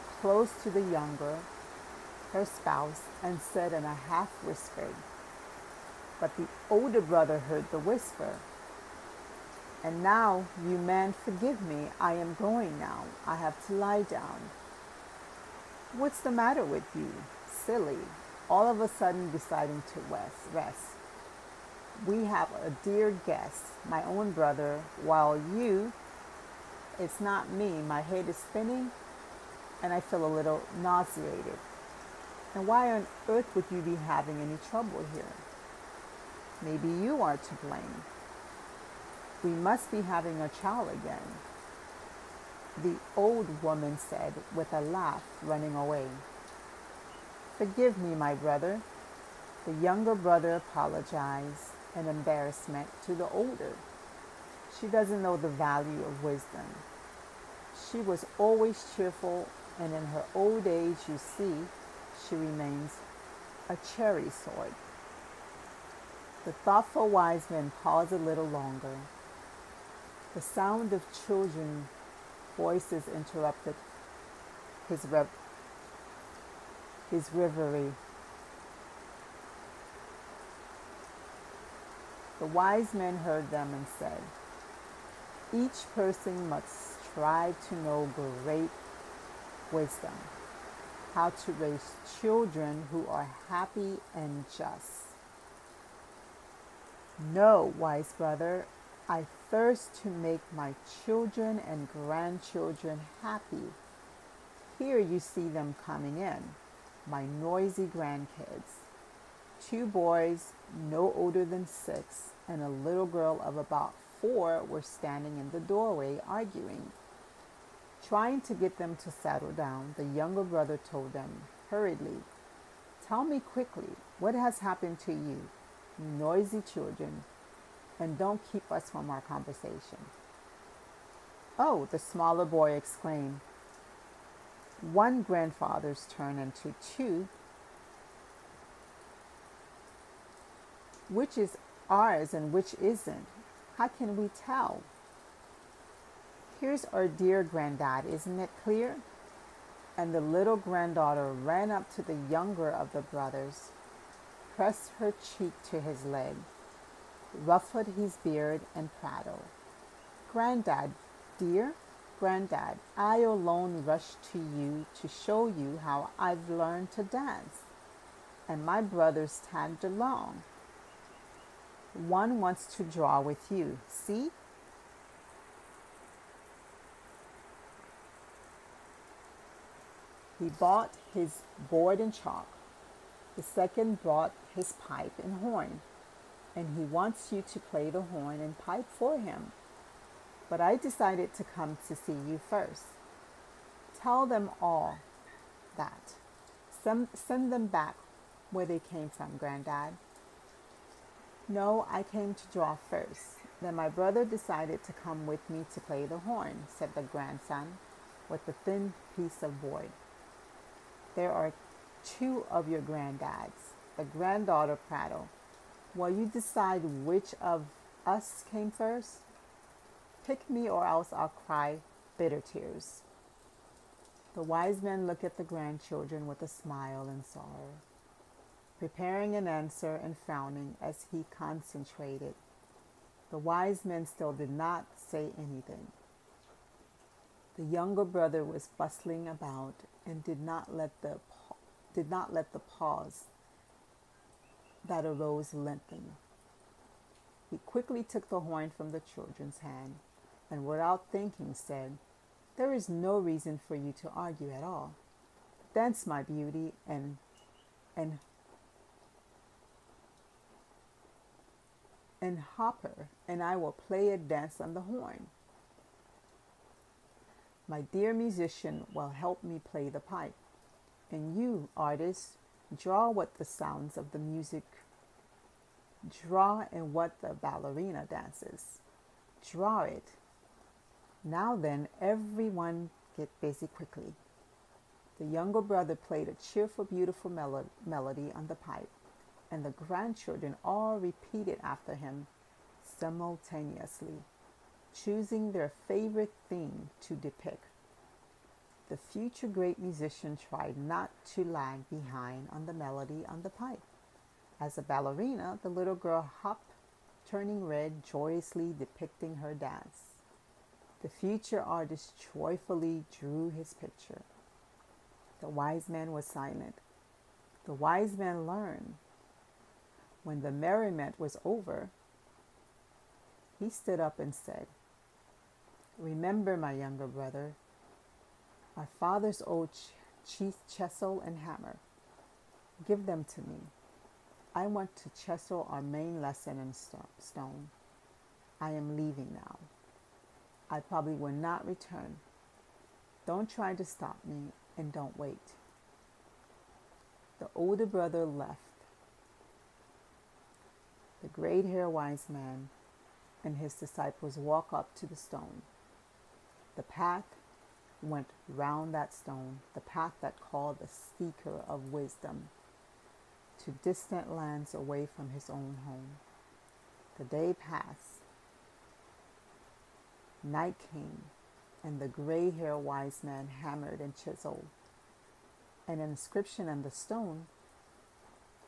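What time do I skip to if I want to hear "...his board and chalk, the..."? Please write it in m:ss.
3:01.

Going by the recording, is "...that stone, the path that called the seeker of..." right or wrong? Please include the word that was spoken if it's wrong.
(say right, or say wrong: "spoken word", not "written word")
right.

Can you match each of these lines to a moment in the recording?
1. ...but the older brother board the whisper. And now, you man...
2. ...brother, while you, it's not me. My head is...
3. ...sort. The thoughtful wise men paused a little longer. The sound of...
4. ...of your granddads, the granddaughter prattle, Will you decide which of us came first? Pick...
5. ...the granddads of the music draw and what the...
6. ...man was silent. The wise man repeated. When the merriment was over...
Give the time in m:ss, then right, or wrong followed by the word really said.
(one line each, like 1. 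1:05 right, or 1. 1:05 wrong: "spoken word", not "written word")
1. 0:06 wrong: "heard", not "board"
2. 0:24 right
3. 1:04 right
4. 3:32 right
5. 4:33 wrong: "sounds", not "granddads"
6. 5:15 wrong: "learned", not "repeated".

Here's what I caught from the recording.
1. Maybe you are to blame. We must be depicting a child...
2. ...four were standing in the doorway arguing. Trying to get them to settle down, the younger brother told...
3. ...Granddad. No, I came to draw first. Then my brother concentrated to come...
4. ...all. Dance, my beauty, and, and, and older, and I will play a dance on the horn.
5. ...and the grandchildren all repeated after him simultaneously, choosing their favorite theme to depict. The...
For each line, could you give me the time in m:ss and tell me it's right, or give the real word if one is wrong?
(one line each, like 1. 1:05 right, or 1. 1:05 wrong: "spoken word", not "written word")
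1. 0:36 wrong: "having", not "depicting"
2. 1:54 right
3. 3:19 wrong: "decided", not "concentrated"
4. 4:14 wrong: "hopper", not "older"
5. 4:49 right.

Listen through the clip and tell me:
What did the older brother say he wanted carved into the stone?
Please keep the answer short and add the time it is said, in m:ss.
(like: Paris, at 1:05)
Our main lesson, at 5:35.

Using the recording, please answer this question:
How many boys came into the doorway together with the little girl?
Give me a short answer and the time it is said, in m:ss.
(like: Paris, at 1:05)
2, at 1:49.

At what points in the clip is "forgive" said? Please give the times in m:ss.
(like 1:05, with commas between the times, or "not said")
0:11, 0:47.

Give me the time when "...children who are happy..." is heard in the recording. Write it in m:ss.
1:32.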